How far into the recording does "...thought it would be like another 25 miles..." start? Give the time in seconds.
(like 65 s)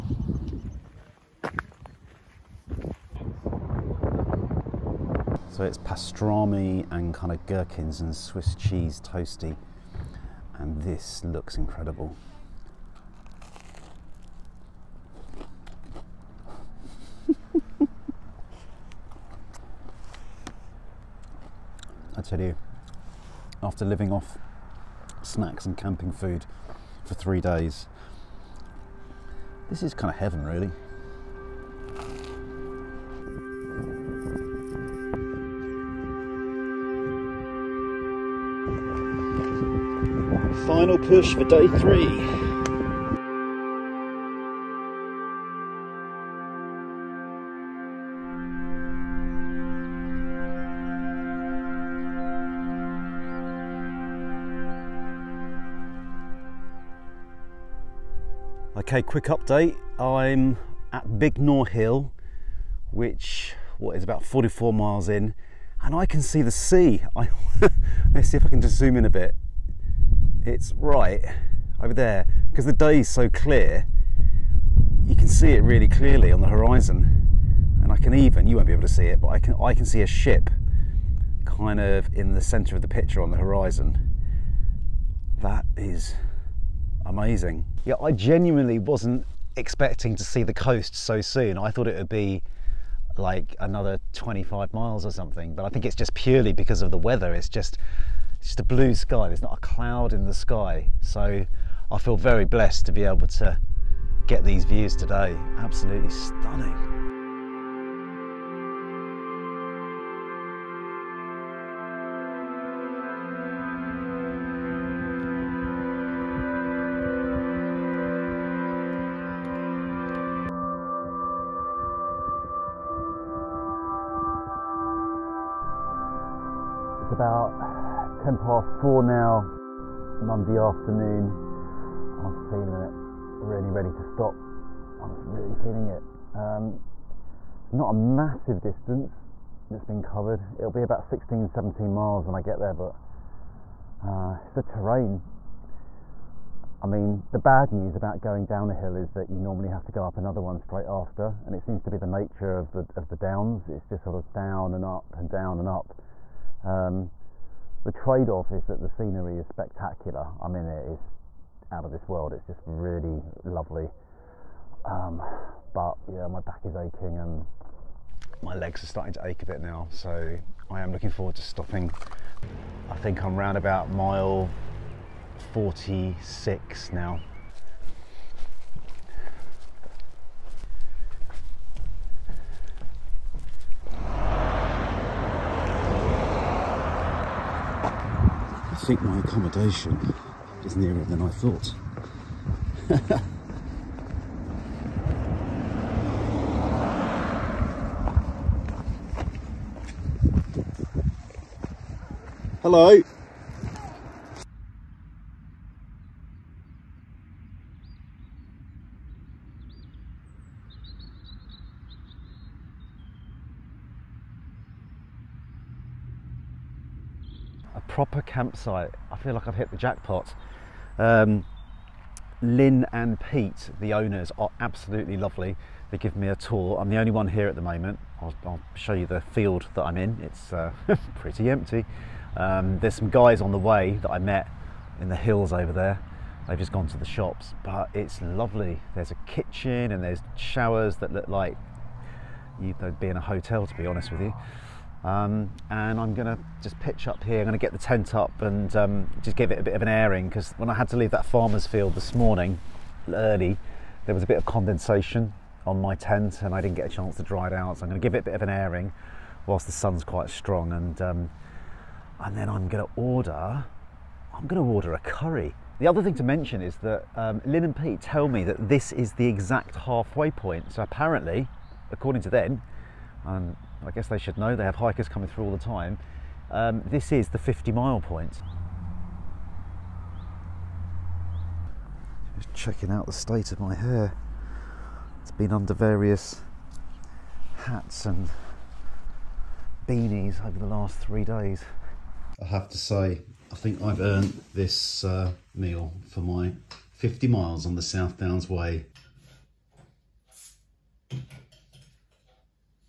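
91 s.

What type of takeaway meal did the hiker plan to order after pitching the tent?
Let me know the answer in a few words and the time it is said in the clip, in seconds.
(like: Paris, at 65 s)
Curry, at 264 s.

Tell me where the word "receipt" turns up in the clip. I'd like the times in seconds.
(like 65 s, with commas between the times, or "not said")
not said.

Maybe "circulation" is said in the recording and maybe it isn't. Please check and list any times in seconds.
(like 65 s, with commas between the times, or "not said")
not said.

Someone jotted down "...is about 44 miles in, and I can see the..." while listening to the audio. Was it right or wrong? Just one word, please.
right.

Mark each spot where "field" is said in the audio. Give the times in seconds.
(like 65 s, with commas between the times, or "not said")
229 s, 251 s.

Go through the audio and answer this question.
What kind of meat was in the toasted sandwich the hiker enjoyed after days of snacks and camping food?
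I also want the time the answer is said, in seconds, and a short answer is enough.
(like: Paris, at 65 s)
Pastrami, at 5 s.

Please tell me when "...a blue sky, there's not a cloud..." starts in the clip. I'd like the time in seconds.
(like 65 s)
98 s.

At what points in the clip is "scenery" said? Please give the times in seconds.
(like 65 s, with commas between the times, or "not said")
158 s.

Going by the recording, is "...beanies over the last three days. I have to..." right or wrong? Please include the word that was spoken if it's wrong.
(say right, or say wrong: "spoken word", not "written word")
right.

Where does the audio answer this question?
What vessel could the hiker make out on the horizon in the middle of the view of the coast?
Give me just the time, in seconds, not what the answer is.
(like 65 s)
80 s.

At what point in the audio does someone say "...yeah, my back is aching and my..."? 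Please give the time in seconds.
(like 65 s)
166 s.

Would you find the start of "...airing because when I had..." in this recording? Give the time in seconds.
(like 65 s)
249 s.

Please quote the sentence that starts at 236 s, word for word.
They've just gone to the shops, but it's lovely.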